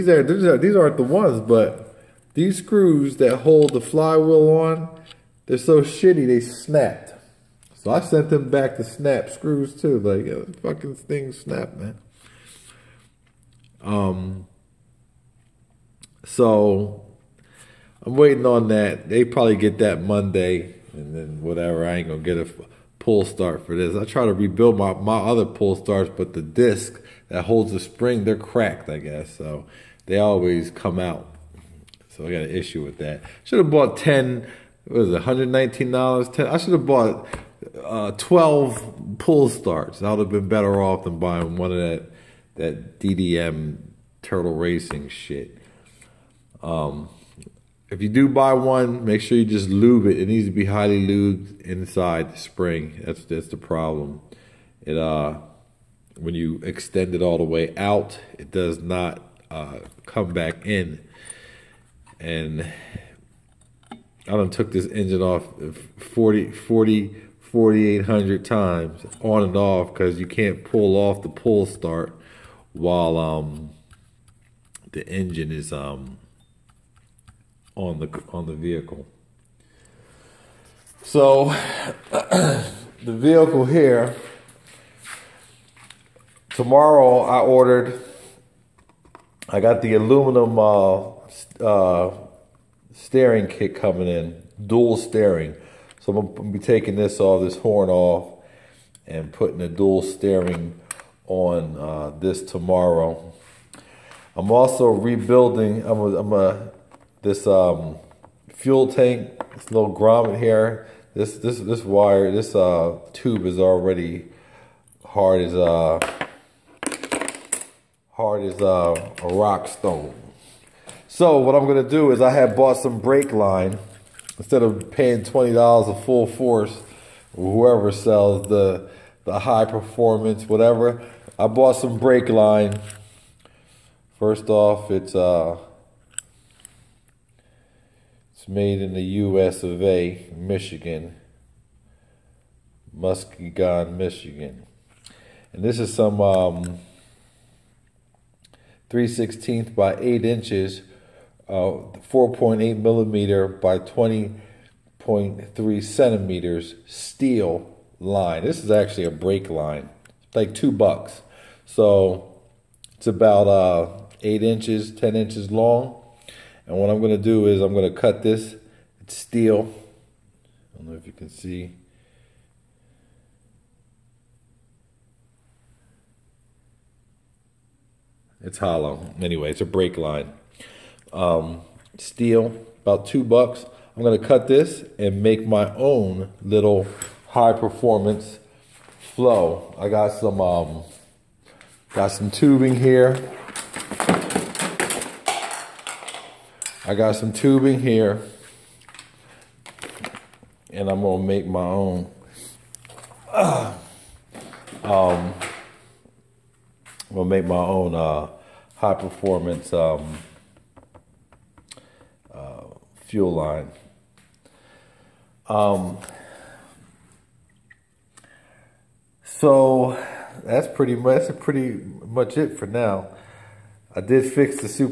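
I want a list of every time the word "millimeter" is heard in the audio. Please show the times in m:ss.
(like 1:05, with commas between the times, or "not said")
2:32.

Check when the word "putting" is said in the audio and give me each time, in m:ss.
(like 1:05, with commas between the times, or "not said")
1:39.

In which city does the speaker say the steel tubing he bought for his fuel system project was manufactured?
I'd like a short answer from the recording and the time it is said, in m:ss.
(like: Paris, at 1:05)
Muskegon, Michigan, at 2:22.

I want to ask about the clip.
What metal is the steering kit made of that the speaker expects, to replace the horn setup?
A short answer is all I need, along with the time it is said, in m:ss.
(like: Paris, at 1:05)
aluminum, at 1:29.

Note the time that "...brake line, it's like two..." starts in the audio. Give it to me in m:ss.
2:39.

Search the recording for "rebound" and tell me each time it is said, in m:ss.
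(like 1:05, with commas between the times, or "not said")
not said.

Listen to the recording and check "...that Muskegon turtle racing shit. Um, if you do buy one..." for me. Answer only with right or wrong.
wrong.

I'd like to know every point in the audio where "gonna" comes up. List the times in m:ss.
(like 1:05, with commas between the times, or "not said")
0:22, 1:36, 2:01, 3:21, 3:27.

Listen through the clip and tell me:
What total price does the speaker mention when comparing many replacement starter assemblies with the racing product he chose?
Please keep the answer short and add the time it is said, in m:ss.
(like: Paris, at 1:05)
$119, at 0:35.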